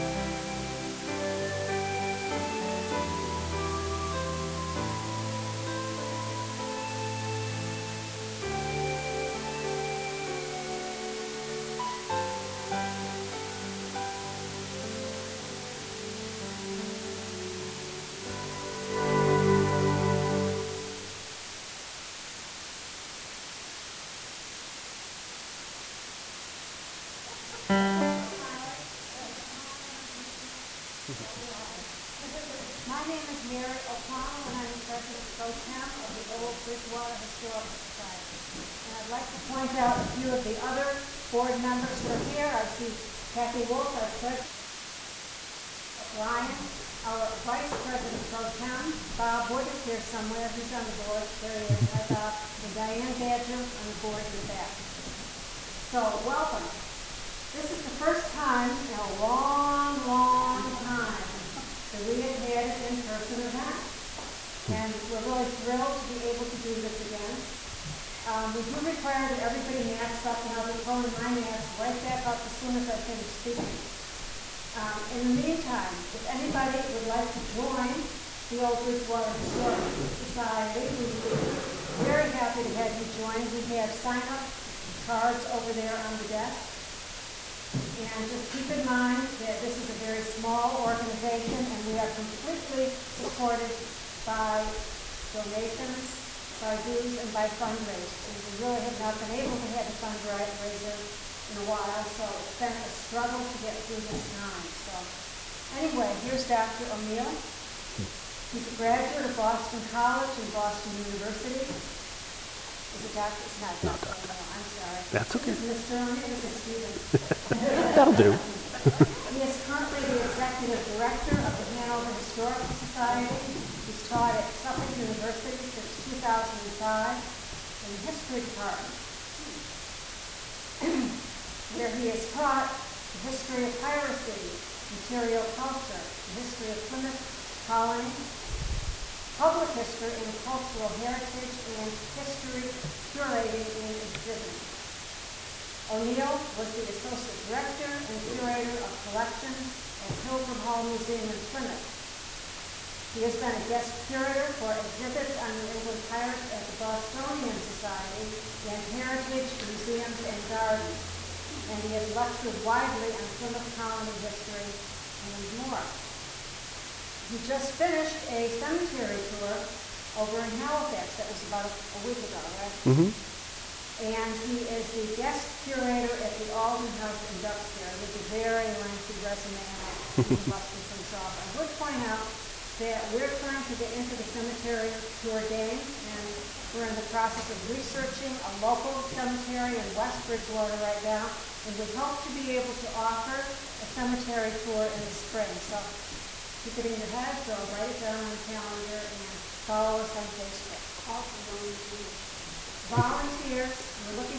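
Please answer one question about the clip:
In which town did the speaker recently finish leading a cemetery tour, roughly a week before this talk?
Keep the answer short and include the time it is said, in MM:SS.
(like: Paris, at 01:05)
Halifax, at 02:50.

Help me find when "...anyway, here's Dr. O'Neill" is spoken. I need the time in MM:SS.
01:45.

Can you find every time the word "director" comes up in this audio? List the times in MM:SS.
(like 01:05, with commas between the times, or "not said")
02:00, 02:27.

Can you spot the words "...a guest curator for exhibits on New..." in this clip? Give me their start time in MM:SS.
02:33.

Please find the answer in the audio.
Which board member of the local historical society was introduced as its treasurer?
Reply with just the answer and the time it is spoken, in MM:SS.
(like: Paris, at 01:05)
Kathy Wolf, at 00:43.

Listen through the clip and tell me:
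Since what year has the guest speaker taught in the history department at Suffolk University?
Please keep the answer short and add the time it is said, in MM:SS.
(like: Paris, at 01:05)
2005, at 02:06.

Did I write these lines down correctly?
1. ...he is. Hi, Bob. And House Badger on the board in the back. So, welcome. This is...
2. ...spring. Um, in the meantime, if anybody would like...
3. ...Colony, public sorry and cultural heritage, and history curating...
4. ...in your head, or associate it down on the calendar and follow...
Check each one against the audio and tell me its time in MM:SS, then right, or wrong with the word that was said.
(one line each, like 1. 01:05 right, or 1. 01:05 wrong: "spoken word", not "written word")
1. 00:51 wrong: "Diane", not "House"
2. 01:13 wrong: "speaking", not "spring"
3. 02:17 wrong: "history", not "sorry"
4. 03:16 wrong: "write", not "associate".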